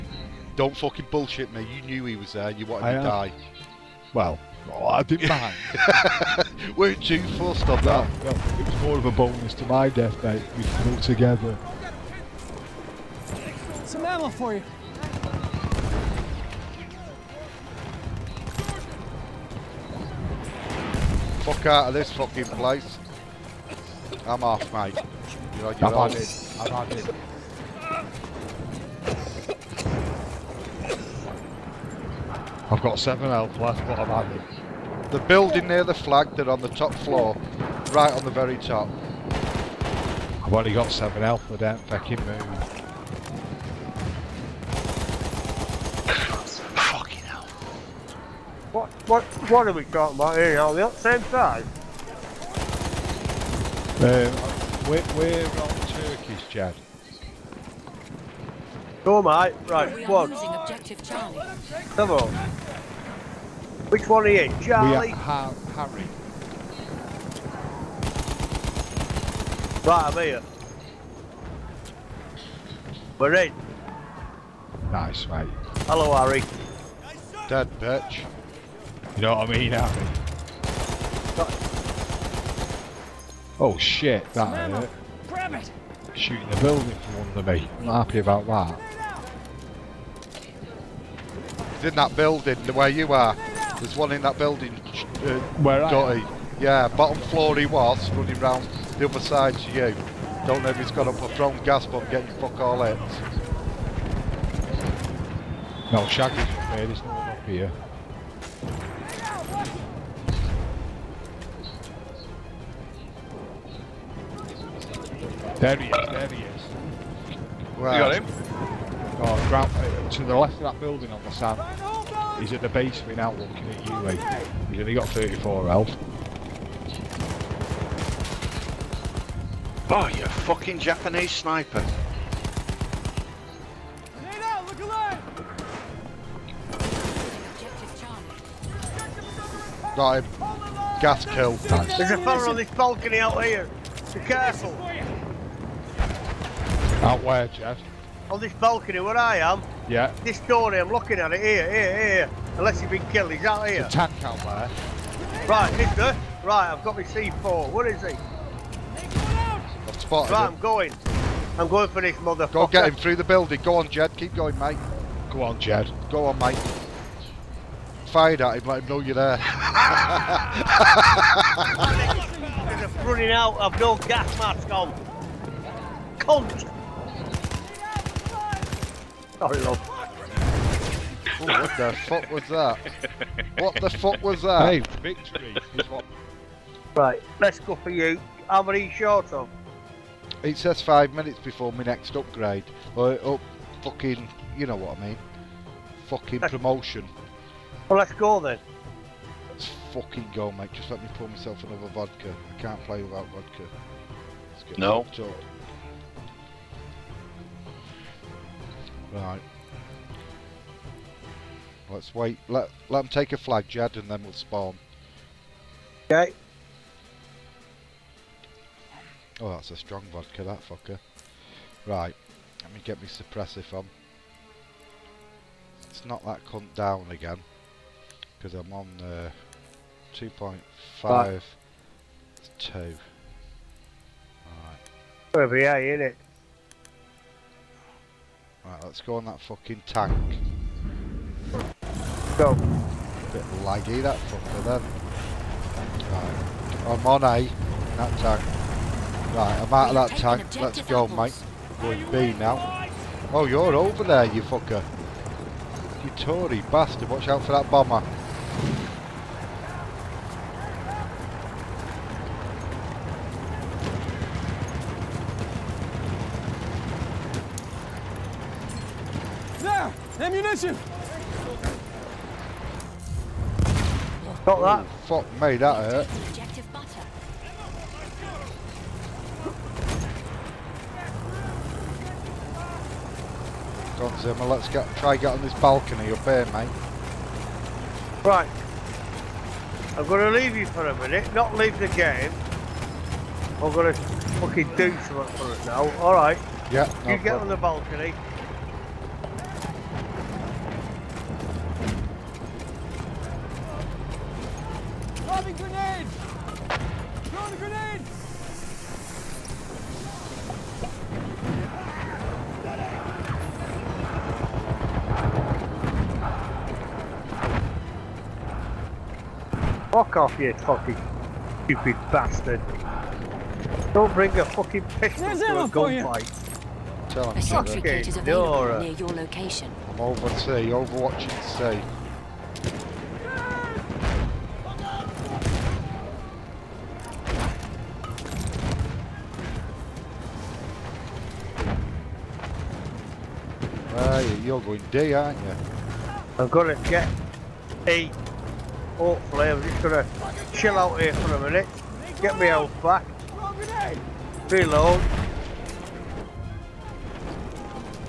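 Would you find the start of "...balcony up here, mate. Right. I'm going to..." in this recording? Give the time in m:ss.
4:45.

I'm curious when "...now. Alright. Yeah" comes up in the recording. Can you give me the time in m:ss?
4:55.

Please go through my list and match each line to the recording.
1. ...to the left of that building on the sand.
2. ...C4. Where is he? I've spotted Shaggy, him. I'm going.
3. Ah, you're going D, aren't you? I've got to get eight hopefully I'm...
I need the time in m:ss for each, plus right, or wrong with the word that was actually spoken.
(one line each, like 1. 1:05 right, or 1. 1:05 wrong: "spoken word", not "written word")
1. 2:00 right
2. 2:37 wrong: "Right", not "Shaggy"
3. 5:43 right.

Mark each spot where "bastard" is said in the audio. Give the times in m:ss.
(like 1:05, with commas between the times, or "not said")
4:16, 5:22.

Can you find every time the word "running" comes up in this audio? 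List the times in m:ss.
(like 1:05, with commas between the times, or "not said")
1:38, 2:53.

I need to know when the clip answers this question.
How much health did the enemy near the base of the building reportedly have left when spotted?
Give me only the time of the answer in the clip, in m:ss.
2:05.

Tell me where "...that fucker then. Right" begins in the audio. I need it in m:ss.
4:03.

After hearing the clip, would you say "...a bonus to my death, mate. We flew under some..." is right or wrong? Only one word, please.
wrong.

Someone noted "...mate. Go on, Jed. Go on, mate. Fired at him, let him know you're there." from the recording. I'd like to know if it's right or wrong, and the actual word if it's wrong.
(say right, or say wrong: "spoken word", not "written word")
right.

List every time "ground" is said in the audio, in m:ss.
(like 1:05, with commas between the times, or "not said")
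1:59.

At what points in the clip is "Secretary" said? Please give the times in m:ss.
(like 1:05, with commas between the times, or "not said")
5:27.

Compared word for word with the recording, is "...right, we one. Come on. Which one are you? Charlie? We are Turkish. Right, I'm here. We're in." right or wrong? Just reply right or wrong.
wrong.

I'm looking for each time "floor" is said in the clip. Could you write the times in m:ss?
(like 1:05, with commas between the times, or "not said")
0:36, 1:37.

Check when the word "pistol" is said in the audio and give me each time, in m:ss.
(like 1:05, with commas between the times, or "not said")
5:24.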